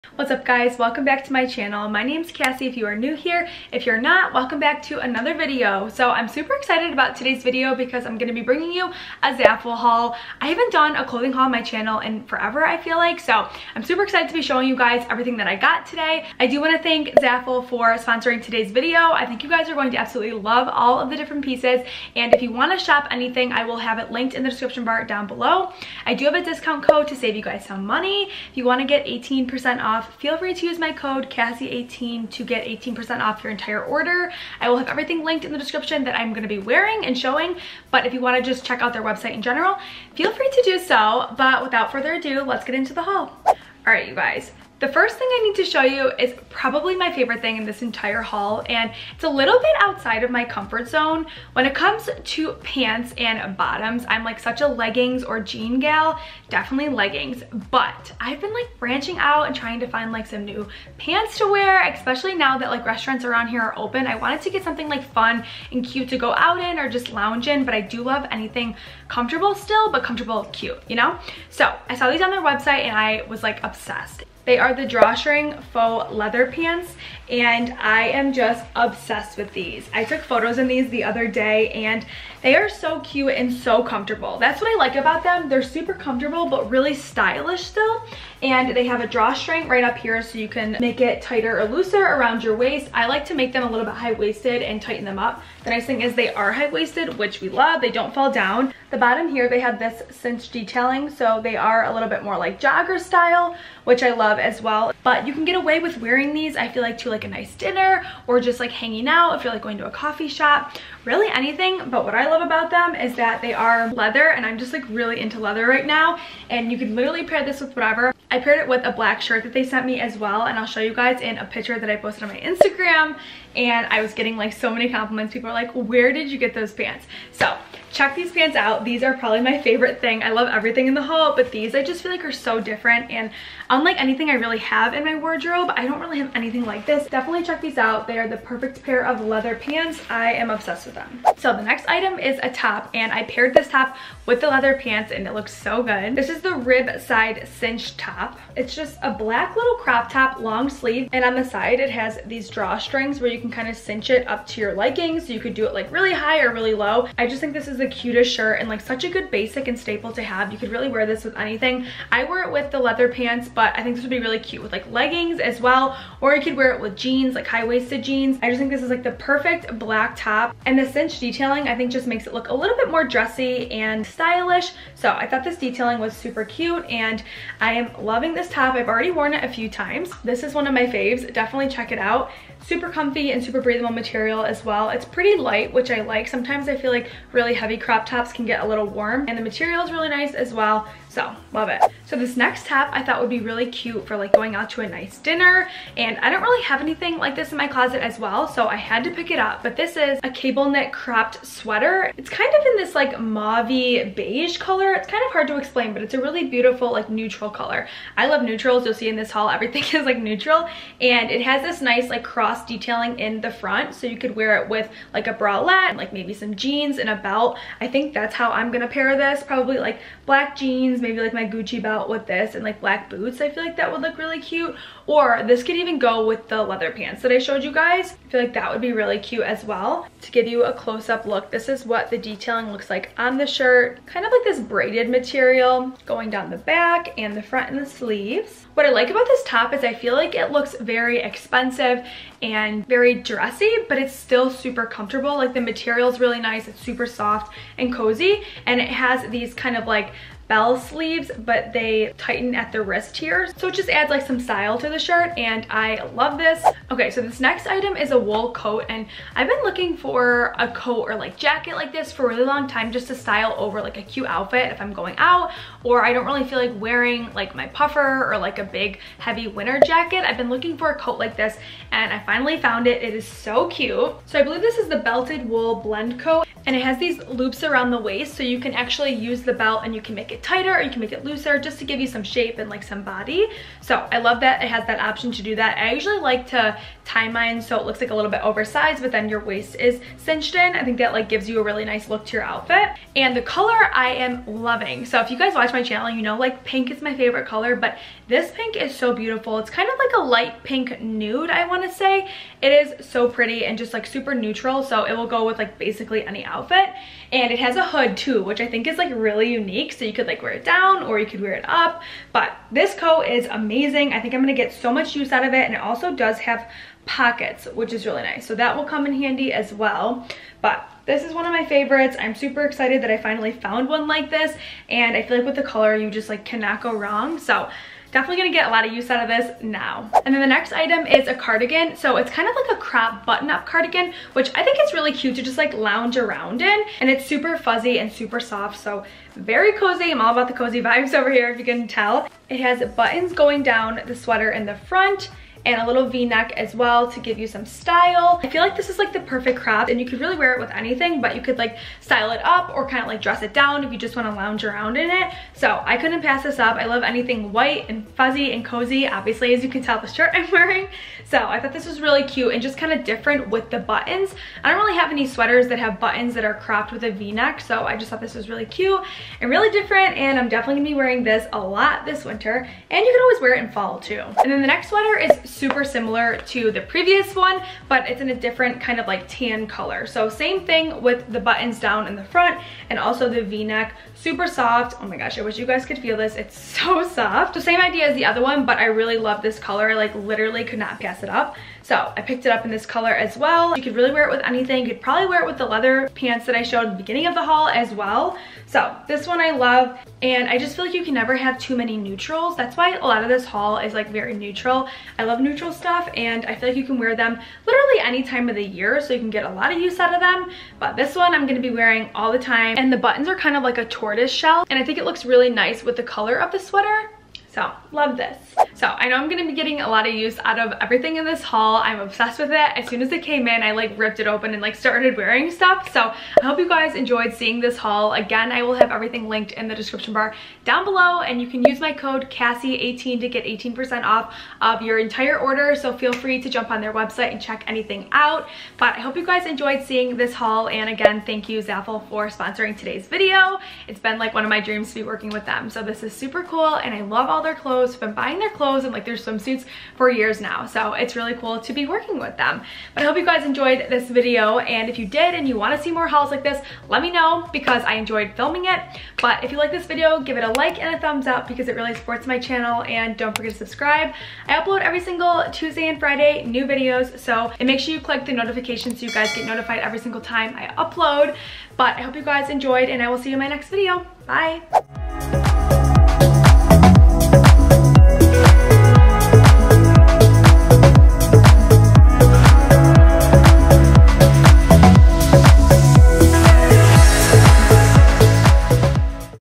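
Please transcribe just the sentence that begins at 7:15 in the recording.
So feel free to jump on their website and check anything out.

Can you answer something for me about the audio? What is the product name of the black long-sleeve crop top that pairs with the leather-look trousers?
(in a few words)
rib side cinch top.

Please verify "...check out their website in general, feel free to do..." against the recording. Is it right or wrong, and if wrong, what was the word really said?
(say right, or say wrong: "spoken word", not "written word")
right.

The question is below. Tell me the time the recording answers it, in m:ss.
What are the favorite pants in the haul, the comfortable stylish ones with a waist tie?
1:14.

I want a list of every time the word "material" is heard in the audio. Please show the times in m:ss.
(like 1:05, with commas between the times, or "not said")
3:03, 3:09, 3:55, 4:05.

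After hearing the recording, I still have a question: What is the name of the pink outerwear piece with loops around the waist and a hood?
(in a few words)
belted wool blend coat.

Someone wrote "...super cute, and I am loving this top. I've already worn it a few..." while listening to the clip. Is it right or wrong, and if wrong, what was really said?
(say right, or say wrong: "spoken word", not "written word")
right.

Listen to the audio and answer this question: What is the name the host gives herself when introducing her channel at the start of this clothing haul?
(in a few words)
Cassie.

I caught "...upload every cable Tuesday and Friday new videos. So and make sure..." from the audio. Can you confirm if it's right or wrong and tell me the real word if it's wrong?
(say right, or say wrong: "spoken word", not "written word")
wrong: "single", not "cable".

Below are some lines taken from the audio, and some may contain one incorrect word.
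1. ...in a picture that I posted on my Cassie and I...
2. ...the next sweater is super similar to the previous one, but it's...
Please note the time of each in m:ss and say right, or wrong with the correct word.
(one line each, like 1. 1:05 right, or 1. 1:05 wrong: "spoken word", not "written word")
1. 2:01 wrong: "Instagram", not "Cassie"
2. 6:14 right.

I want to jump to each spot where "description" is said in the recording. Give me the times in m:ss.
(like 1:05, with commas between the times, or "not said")
0:24, 0:35, 7:09.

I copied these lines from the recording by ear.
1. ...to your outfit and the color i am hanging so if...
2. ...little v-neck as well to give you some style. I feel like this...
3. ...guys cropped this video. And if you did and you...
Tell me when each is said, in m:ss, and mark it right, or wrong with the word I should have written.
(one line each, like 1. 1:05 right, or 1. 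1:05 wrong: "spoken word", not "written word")
1. 4:52 wrong: "loving", not "hanging"
2. 5:45 right
3. 7:33 wrong: "enjoyed", not "cropped".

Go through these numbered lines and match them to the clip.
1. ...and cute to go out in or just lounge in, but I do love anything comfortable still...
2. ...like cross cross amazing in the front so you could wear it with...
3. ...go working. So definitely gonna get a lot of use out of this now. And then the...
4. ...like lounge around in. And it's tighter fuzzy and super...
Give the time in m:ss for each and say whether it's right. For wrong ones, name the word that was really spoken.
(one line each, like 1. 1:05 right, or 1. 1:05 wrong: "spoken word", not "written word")
1. 1:05 right
2. 3:32 wrong: "detailing", not "amazing"
3. 5:26 wrong: "wrong", not "working"
4. 5:35 wrong: "super", not "tighter".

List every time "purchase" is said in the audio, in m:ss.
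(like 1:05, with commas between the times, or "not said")
not said.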